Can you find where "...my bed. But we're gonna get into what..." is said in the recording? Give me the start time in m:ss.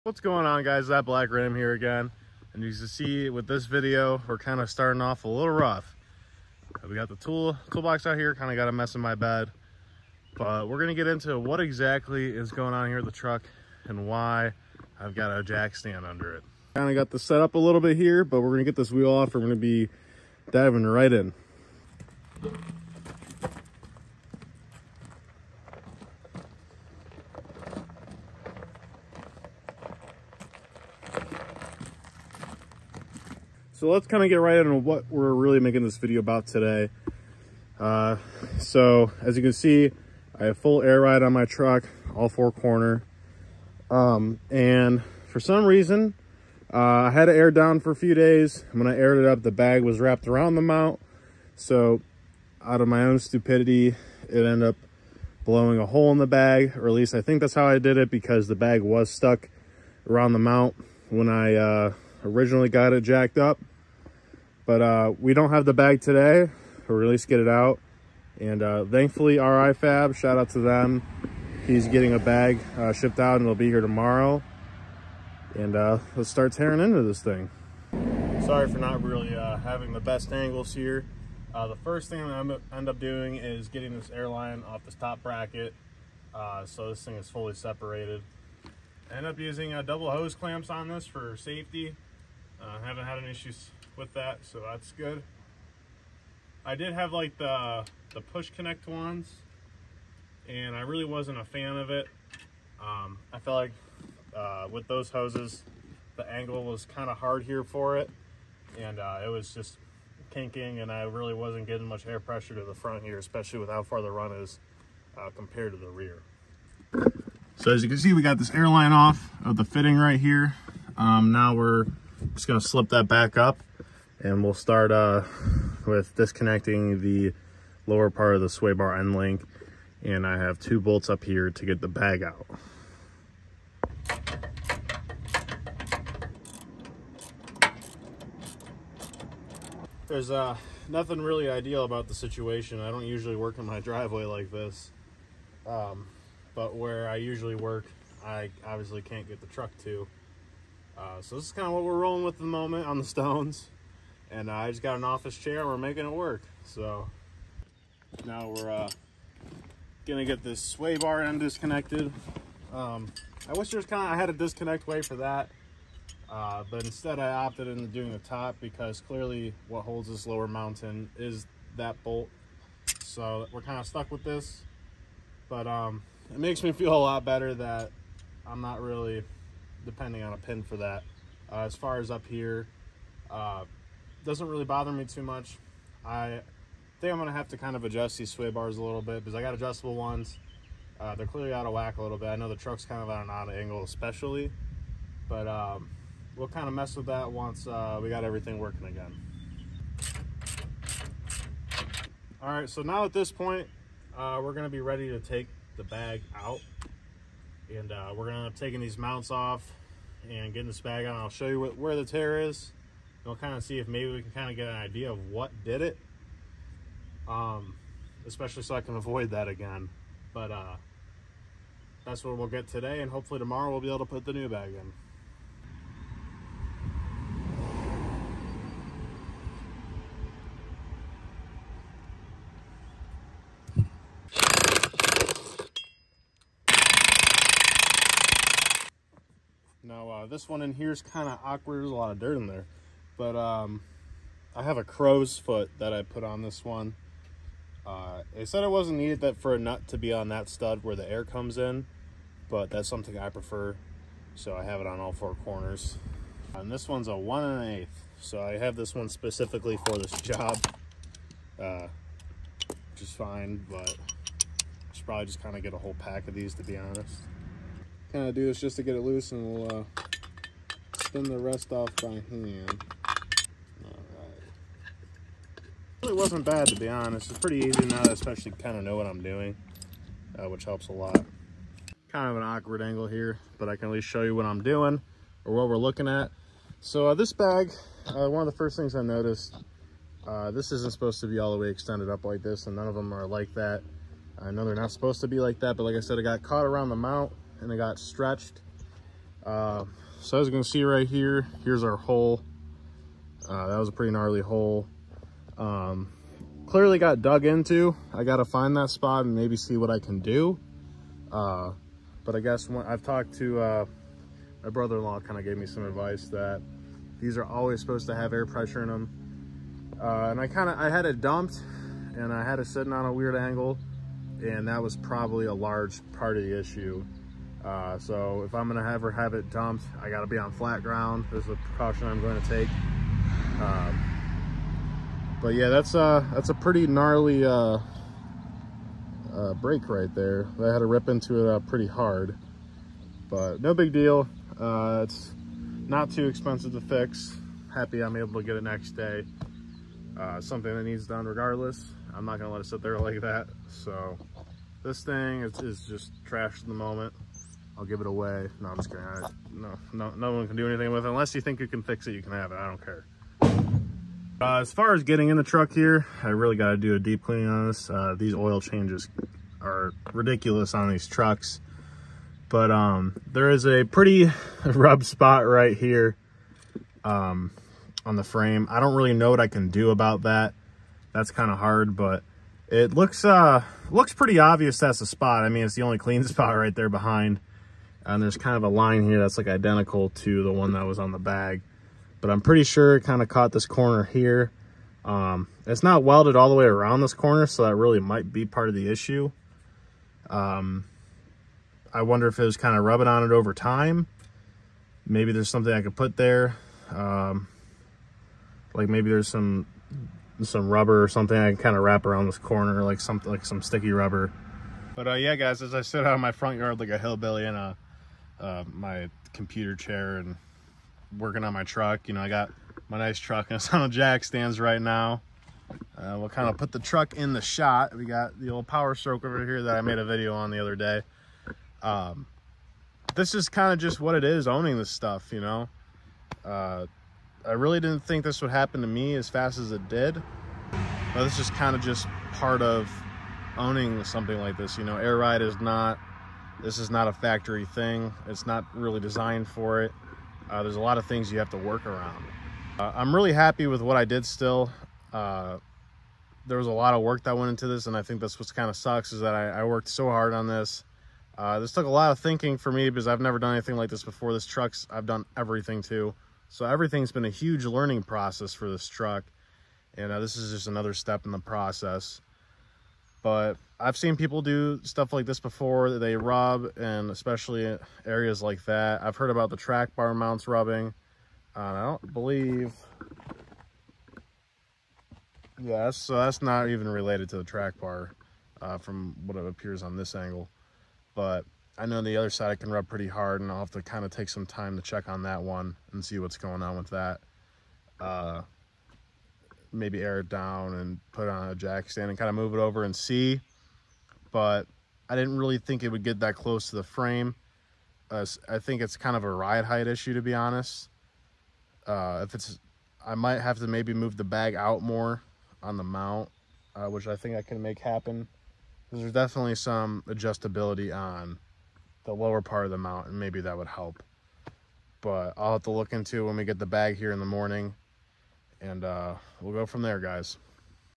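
0:09.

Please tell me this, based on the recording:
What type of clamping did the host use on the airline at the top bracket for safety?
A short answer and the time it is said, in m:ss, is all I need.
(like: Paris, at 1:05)
double hose clamps, at 1:29.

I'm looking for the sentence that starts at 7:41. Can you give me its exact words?
Uh, this took a lot of thinking for me because I've never done anything like this before.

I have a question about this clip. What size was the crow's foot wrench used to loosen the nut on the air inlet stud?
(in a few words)
1 1/8.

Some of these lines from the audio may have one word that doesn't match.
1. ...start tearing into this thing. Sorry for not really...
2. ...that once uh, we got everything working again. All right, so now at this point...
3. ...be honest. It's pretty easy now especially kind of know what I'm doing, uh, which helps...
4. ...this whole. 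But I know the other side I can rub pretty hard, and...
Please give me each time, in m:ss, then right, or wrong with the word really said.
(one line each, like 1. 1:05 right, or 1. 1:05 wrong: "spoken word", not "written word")
1. 1:16 right
2. 3:17 right
3. 4:36 right
4. 8:09 wrong: "angle", not "whole".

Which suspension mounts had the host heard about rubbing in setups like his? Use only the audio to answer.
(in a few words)
track bar mounts.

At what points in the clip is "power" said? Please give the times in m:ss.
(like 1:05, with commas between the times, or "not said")
7:08.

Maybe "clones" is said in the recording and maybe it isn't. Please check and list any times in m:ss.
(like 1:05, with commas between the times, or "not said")
not said.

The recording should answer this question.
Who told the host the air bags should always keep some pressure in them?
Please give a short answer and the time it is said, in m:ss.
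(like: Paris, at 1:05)
brother-in-law, at 5:14.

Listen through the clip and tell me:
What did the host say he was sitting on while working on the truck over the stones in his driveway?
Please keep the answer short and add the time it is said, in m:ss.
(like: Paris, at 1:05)
an office chair, at 2:35.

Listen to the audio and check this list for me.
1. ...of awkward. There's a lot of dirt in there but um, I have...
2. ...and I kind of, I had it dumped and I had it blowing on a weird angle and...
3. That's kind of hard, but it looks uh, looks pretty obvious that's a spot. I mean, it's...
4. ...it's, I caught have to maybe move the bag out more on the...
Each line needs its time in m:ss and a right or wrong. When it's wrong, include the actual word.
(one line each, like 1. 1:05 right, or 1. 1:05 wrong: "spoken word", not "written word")
1. 4:01 right
2. 5:20 wrong: "sitting", not "blowing"
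3. 6:21 right
4. 8:32 wrong: "might", not "caught".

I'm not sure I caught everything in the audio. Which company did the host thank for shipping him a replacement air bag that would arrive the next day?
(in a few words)
RI Fab.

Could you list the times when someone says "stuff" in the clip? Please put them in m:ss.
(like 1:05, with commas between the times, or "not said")
7:14, 7:54.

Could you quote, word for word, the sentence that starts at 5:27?
Uh, so if I'm gonna ever have, have it dumped, I gotta be on flat ground.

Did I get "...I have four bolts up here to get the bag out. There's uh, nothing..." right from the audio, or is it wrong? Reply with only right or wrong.
wrong.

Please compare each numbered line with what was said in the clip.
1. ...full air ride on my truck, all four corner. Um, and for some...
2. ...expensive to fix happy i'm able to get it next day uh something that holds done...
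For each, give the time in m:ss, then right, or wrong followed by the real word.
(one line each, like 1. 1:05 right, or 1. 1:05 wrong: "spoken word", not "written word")
1. 0:40 right
2. 5:46 wrong: "needs", not "holds".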